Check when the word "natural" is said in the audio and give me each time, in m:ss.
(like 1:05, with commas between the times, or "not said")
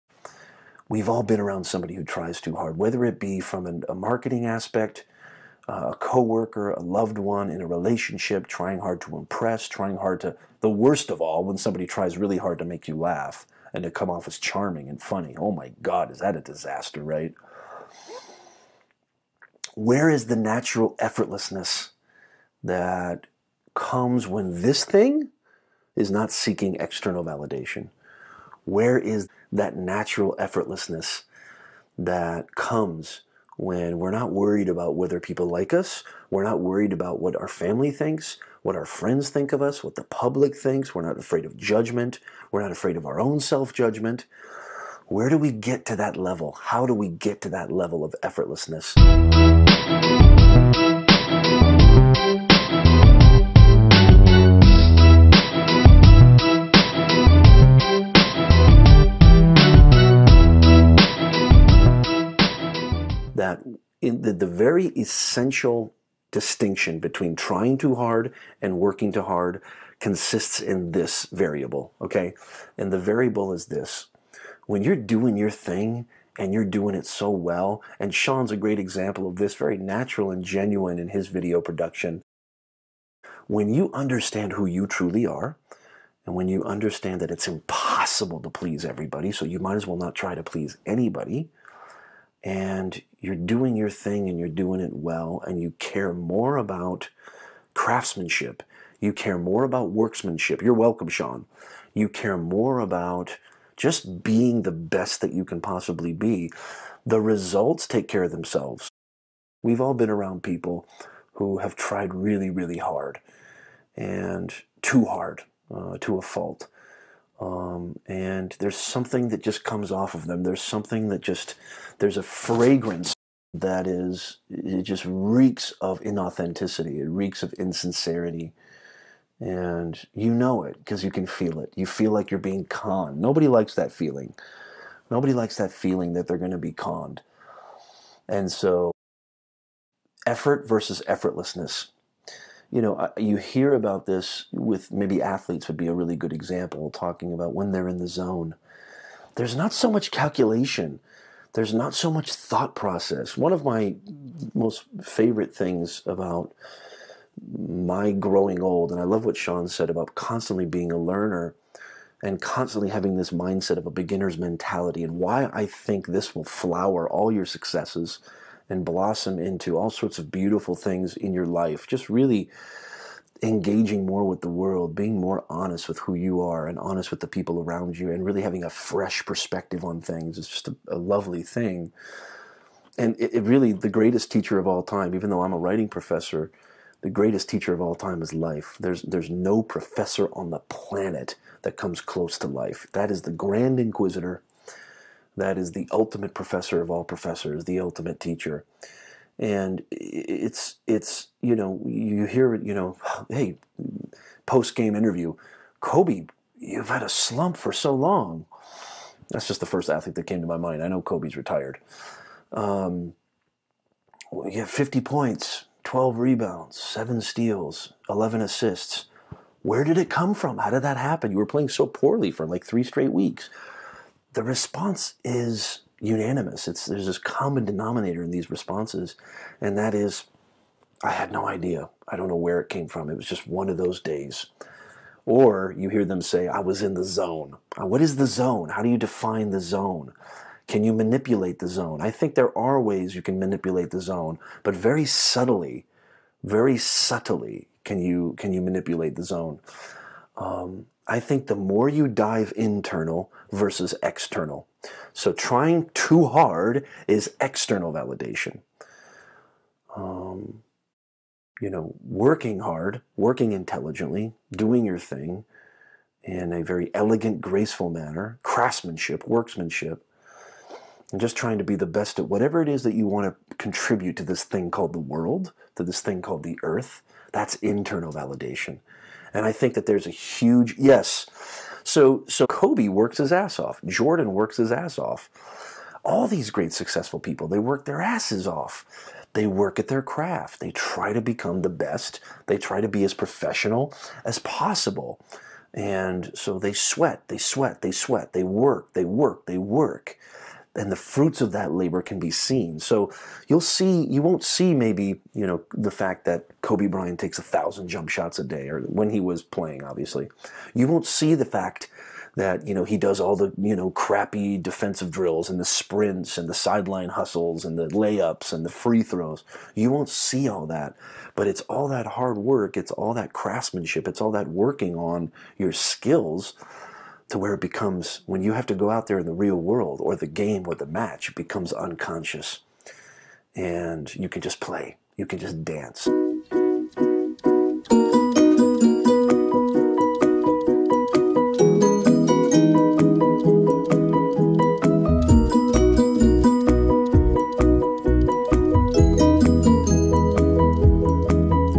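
0:20, 0:29, 1:19.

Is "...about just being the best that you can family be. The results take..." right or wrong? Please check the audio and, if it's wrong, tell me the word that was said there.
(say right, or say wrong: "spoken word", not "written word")
wrong: "possibly", not "family".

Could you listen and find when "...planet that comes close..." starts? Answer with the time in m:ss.
3:10.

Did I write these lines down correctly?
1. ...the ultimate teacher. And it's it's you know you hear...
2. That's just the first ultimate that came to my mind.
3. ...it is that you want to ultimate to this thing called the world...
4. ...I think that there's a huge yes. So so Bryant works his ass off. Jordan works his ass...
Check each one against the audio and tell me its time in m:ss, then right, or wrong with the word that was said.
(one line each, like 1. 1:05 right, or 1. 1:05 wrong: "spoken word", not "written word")
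1. 3:17 right
2. 3:29 wrong: "athlete", not "ultimate"
3. 4:32 wrong: "contribute", not "ultimate"
4. 4:39 wrong: "Kobe", not "Bryant".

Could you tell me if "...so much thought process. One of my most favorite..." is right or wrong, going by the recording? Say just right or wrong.
right.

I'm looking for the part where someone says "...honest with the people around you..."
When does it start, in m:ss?
2:56.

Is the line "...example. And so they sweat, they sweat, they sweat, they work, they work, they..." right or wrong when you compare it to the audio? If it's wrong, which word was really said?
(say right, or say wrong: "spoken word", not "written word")
wrong: "possible", not "example".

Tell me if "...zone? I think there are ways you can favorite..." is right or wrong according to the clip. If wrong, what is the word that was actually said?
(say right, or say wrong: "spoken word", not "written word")
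wrong: "manipulate", not "favorite".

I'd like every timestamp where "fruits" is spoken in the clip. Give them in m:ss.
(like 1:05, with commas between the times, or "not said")
5:00.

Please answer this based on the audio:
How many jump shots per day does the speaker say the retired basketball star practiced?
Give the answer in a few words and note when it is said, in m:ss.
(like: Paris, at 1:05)
1000, at 5:07.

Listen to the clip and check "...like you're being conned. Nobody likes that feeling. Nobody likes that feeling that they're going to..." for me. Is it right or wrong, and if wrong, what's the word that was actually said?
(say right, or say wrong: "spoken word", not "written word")
right.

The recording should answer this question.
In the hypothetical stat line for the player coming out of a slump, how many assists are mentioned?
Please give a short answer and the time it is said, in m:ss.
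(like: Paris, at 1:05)
11, at 3:38.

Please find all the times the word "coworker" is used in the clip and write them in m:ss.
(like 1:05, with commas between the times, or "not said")
0:05.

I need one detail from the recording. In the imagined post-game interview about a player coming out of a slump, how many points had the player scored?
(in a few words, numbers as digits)
50.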